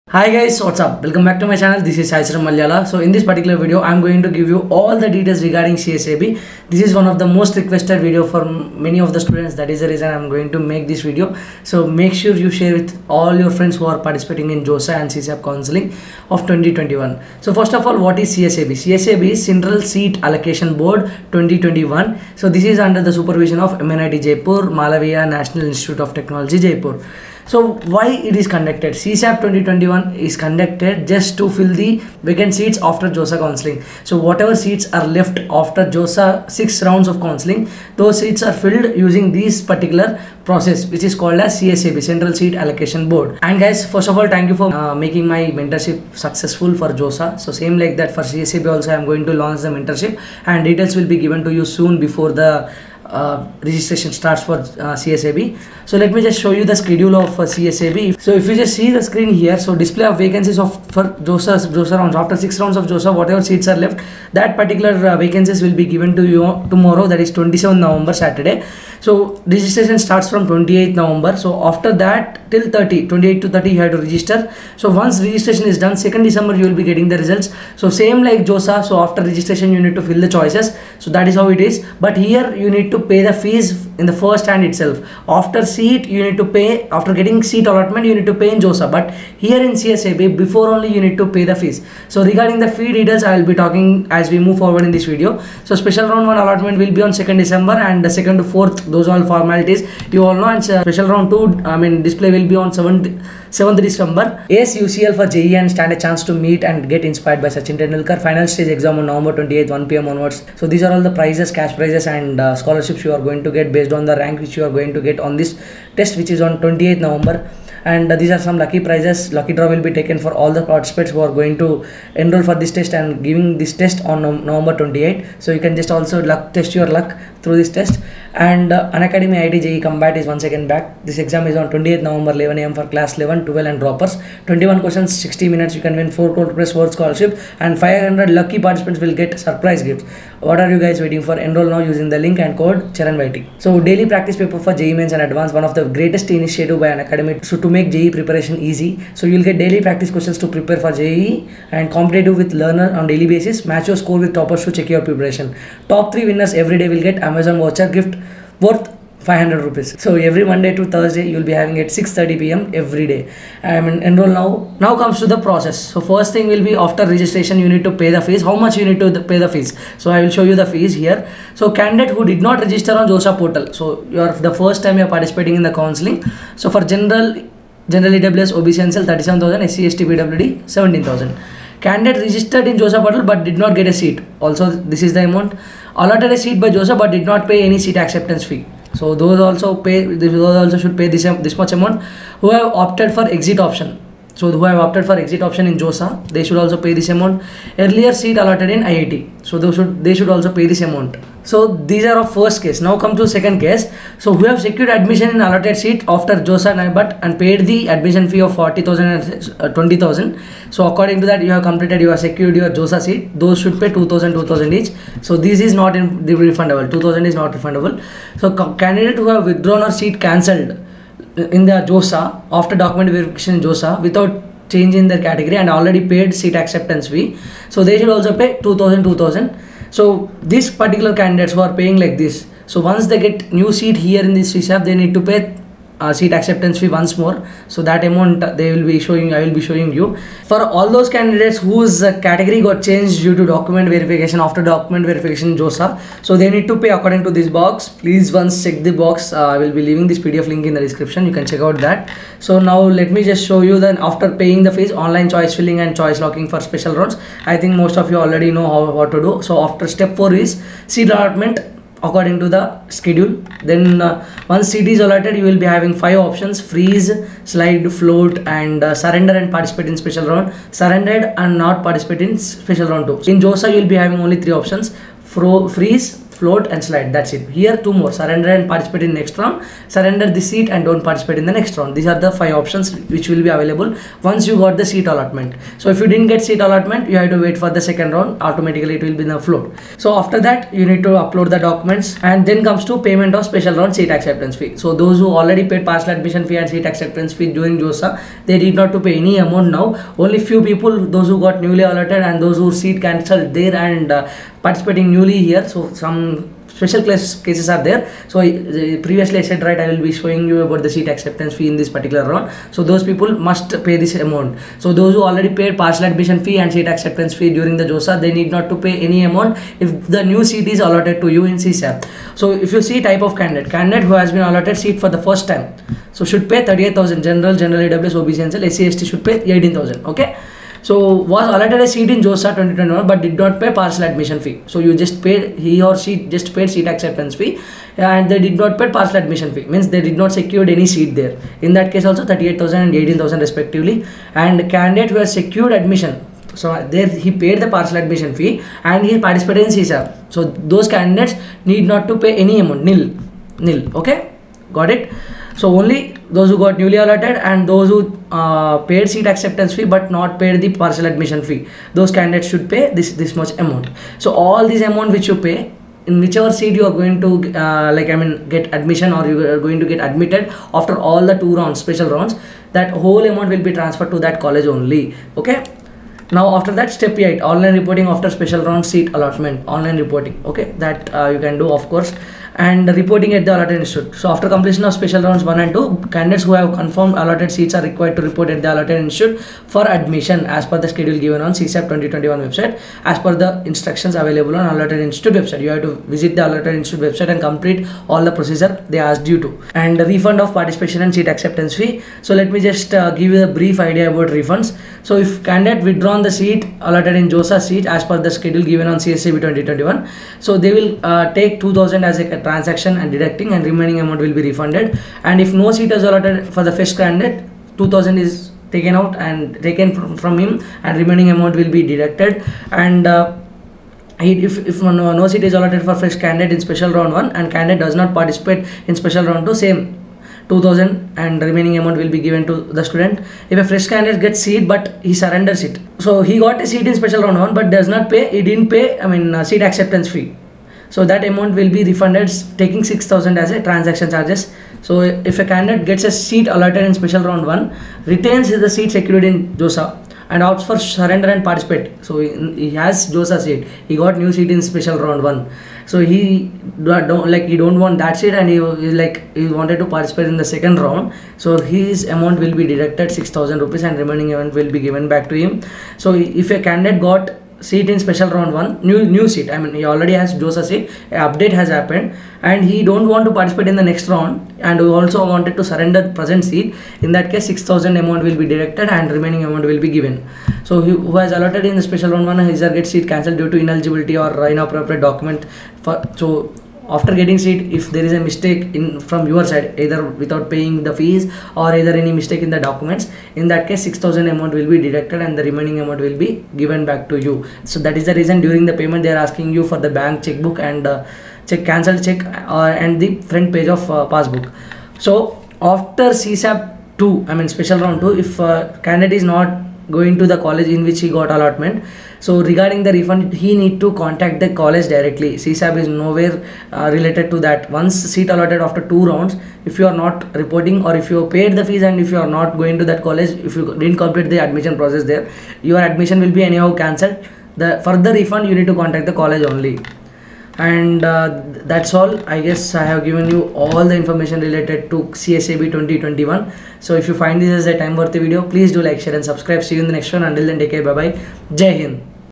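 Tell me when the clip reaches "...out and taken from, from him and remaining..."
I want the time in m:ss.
6:58.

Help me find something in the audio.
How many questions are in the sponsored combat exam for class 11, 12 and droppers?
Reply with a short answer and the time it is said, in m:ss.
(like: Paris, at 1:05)
21, at 2:14.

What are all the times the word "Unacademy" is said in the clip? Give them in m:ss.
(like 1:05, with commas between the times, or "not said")
2:08, 2:26.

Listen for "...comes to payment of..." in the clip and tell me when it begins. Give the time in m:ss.
4:52.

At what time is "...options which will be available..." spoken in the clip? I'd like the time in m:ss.
4:42.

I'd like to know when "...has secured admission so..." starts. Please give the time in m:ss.
5:45.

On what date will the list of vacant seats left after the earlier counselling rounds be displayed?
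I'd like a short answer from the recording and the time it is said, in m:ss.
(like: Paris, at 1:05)
27 November, at 1:07.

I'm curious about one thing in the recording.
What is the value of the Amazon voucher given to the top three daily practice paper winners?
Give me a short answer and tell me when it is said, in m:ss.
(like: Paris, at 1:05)
500 rupees, at 2:39.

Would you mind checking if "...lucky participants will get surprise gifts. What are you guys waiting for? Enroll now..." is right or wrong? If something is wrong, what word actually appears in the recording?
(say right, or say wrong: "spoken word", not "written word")
right.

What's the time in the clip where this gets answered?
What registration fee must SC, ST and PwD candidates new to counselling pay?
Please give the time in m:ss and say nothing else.
3:00.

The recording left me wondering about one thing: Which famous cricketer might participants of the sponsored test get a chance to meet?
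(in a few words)
Sachin Tendulkar.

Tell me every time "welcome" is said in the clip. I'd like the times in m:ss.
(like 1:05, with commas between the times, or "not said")
0:01.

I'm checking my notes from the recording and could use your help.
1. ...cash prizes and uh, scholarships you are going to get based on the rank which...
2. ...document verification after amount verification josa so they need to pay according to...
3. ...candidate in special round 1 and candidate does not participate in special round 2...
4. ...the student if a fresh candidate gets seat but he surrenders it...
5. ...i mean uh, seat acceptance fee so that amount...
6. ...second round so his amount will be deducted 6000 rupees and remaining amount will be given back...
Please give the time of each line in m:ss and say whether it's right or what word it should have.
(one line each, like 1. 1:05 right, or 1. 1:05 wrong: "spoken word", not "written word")
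1. 1:51 right
2. 4:03 wrong: "document", not "amount"
3. 7:06 right
4. 7:12 right
5. 7:18 right
6. 7:40 right.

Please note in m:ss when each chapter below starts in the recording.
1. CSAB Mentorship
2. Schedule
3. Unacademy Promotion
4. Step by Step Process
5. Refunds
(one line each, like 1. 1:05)
1. 0:43
2. 0:55
3. 1:44
4. 2:44
5. 6:39.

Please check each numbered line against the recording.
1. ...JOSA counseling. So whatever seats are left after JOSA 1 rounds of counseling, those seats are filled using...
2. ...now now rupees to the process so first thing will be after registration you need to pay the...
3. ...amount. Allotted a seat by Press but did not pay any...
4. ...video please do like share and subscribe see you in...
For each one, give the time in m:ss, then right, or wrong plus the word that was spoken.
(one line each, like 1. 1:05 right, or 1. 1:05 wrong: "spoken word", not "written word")
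1. 0:33 wrong: "6", not "1"
2. 2:44 wrong: "comes", not "rupees"
3. 3:05 wrong: "Joseph", not "Press"
4. 8:58 right.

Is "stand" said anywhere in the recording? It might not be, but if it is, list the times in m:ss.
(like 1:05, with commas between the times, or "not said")
1:45.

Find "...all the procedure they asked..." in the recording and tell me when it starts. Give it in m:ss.
6:38.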